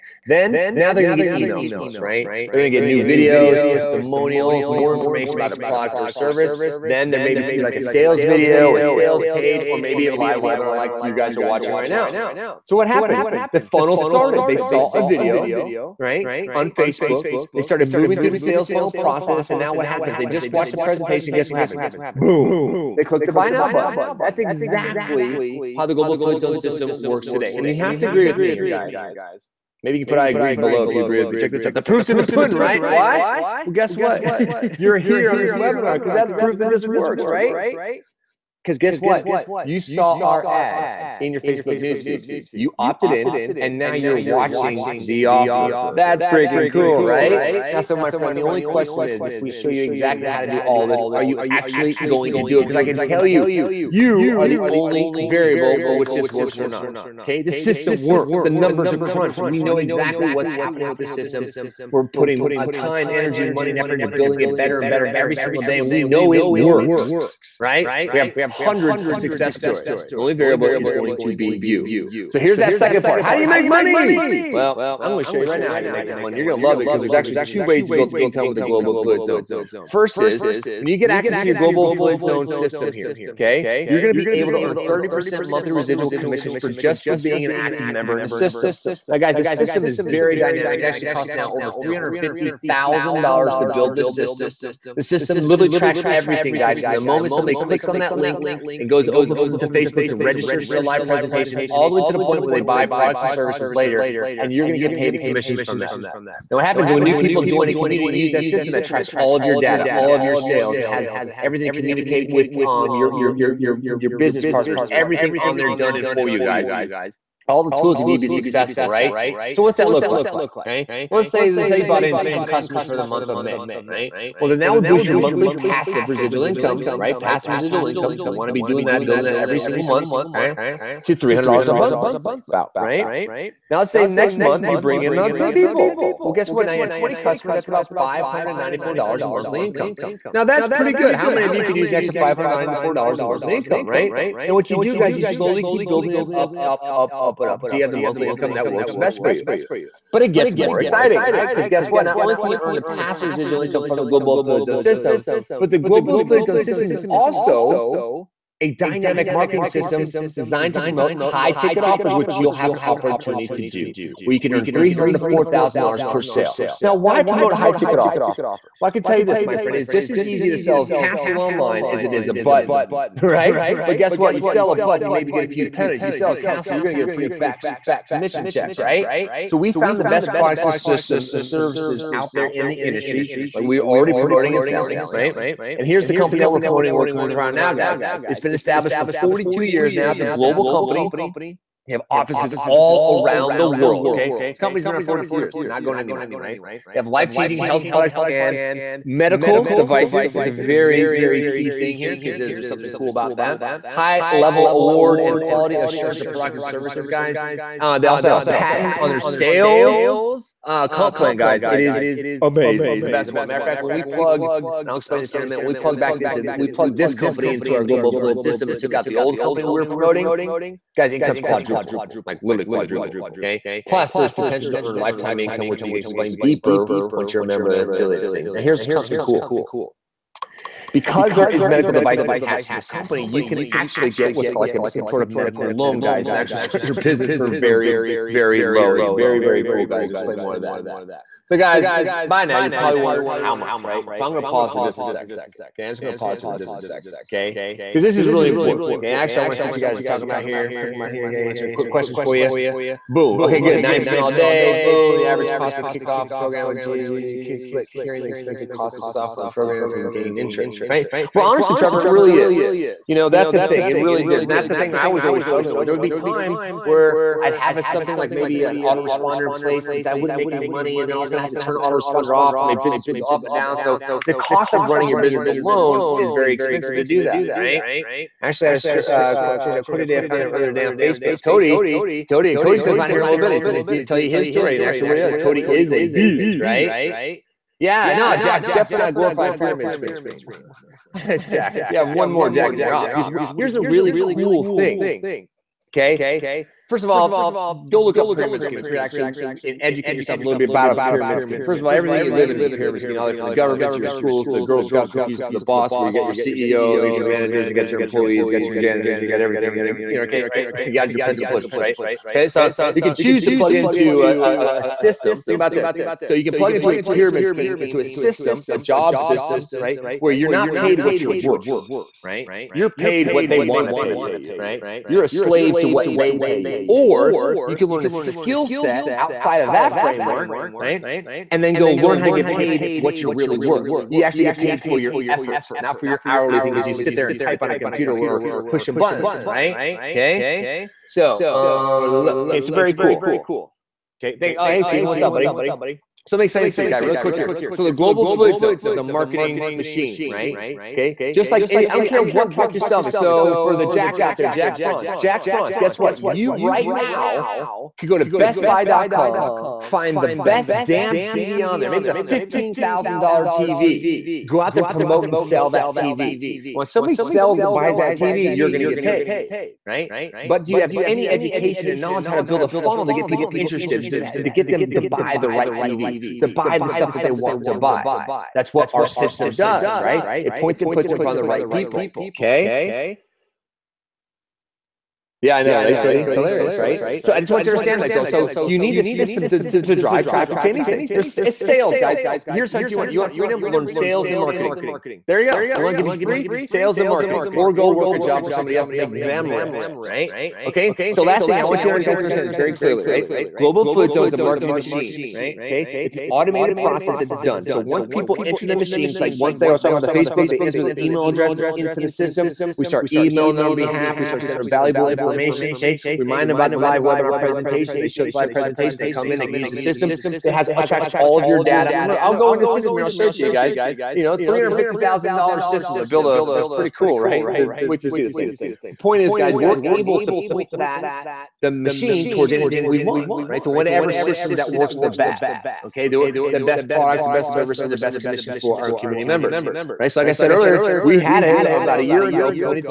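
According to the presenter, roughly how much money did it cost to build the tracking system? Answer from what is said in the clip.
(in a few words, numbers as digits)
$350,000.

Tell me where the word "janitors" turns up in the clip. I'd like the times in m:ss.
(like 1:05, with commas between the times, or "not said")
5:08.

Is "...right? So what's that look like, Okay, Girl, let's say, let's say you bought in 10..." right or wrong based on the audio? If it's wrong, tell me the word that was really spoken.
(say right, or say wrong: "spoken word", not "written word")
wrong: "Well", not "Girl".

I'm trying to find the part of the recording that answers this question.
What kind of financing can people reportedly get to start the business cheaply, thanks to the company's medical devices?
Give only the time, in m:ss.
3:55.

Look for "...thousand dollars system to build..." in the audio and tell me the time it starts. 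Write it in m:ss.
7:04.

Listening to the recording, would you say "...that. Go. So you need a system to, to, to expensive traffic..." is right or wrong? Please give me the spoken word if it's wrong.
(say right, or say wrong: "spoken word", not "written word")
wrong: "drive", not "expensive".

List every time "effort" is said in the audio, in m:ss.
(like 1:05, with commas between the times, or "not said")
1:03, 5:35.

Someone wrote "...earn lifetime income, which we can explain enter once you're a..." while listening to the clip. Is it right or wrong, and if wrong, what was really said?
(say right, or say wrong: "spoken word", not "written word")
wrong: "deeper", not "enter".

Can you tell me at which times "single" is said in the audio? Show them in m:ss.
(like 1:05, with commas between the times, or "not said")
1:05, 2:09.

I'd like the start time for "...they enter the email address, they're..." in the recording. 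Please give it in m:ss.
6:50.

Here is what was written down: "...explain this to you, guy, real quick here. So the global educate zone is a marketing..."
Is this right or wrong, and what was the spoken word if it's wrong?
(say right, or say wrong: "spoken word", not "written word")
wrong: "affiliate", not "educate".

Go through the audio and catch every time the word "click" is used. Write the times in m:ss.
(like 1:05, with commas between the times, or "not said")
0:23, 1:37.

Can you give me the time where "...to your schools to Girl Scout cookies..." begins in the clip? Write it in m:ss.
5:03.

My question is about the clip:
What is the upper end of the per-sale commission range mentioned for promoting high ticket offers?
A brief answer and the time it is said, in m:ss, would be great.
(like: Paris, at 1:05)
$4,000, at 2:45.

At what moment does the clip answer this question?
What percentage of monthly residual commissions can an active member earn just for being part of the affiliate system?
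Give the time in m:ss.
1:24.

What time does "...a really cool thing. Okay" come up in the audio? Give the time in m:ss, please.
4:53.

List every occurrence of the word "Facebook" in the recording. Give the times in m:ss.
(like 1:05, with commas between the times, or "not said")
0:16, 0:41, 1:39, 4:41, 6:50.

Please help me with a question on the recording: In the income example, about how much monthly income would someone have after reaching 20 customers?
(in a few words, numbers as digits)
$594.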